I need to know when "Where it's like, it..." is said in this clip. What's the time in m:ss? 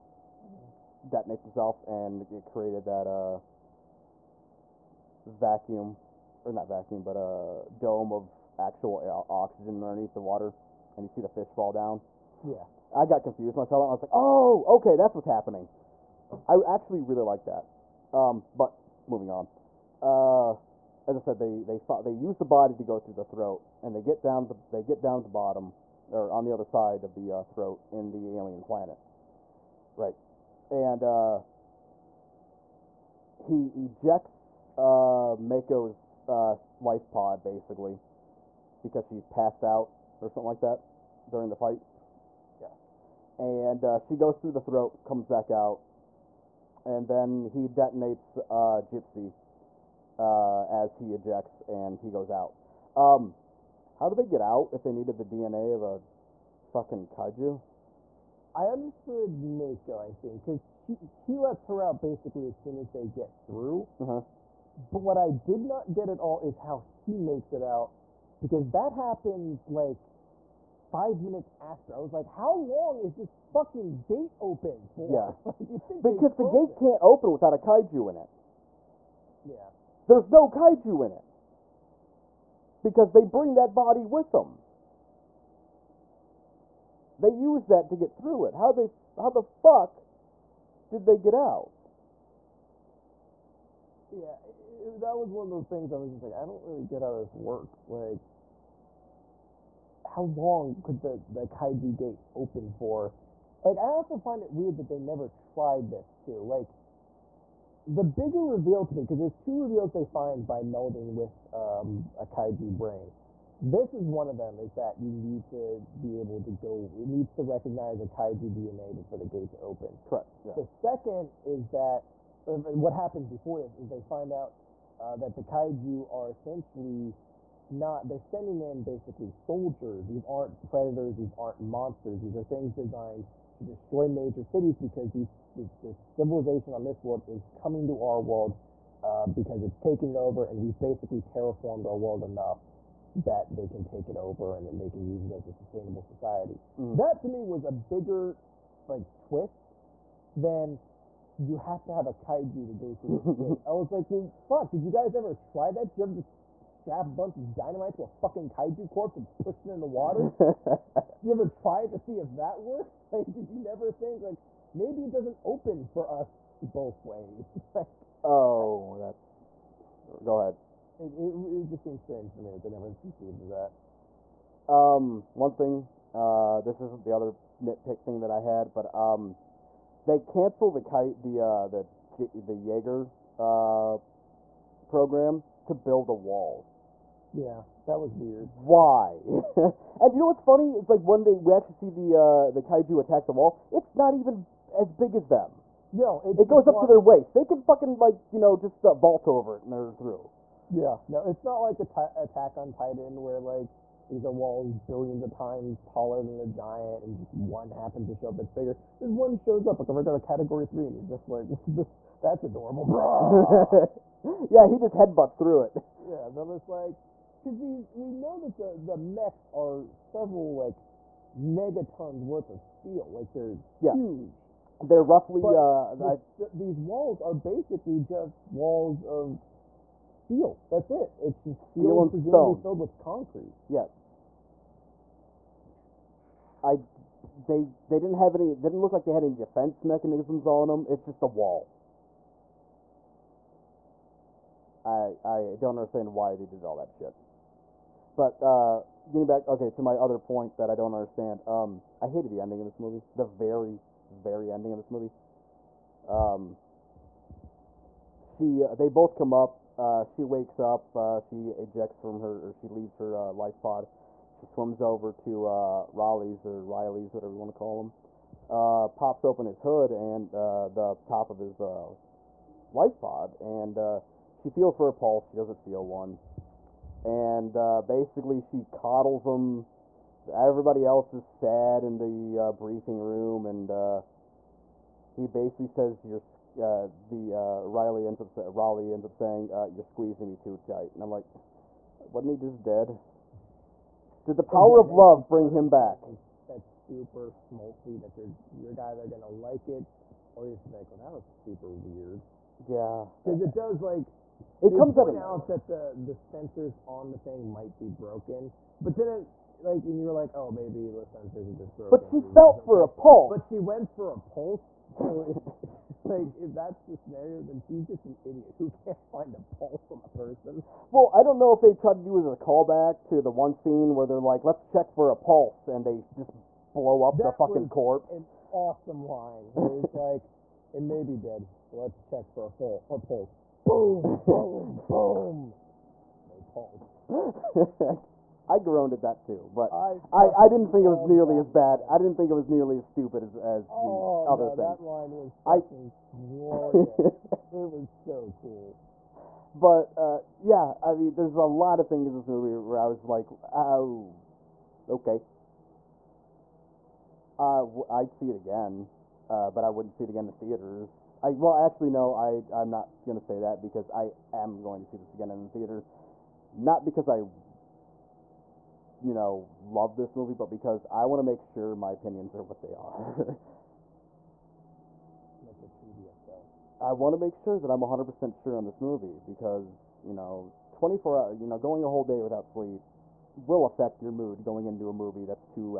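5:29.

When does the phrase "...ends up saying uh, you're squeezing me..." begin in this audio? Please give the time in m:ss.
4:48.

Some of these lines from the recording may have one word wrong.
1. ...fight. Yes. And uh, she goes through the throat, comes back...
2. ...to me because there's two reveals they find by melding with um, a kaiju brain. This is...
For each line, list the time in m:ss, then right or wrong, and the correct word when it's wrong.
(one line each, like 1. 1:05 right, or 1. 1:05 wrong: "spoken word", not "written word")
1. 0:41 right
2. 1:48 right.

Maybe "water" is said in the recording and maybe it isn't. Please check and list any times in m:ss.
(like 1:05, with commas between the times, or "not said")
0:10, 2:39.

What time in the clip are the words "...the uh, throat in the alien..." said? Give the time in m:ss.
0:27.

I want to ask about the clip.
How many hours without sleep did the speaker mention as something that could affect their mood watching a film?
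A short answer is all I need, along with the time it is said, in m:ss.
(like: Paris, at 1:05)
24, at 6:20.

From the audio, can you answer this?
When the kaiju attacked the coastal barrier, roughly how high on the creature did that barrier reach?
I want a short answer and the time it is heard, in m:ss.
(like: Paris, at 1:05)
their waist, at 3:16.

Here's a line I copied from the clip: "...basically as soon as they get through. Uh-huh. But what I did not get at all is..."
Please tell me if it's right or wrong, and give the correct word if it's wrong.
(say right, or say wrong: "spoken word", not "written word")
right.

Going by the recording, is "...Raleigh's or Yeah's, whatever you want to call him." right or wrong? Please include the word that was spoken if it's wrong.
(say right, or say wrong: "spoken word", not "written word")
wrong: "Riley", not "Yeah".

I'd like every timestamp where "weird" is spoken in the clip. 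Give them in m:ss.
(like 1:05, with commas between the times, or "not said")
1:44, 3:08, 5:01.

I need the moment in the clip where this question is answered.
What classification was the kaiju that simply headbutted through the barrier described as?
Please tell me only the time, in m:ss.
3:30.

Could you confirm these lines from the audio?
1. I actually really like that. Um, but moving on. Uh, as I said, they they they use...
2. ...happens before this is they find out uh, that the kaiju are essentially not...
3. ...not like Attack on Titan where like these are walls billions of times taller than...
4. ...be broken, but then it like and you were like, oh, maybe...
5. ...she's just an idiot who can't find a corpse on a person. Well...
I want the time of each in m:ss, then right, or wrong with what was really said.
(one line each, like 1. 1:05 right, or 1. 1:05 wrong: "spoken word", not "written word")
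1. 0:16 right
2. 2:02 right
3. 3:21 right
4. 5:07 right
5. 5:17 wrong: "pulse", not "corpse".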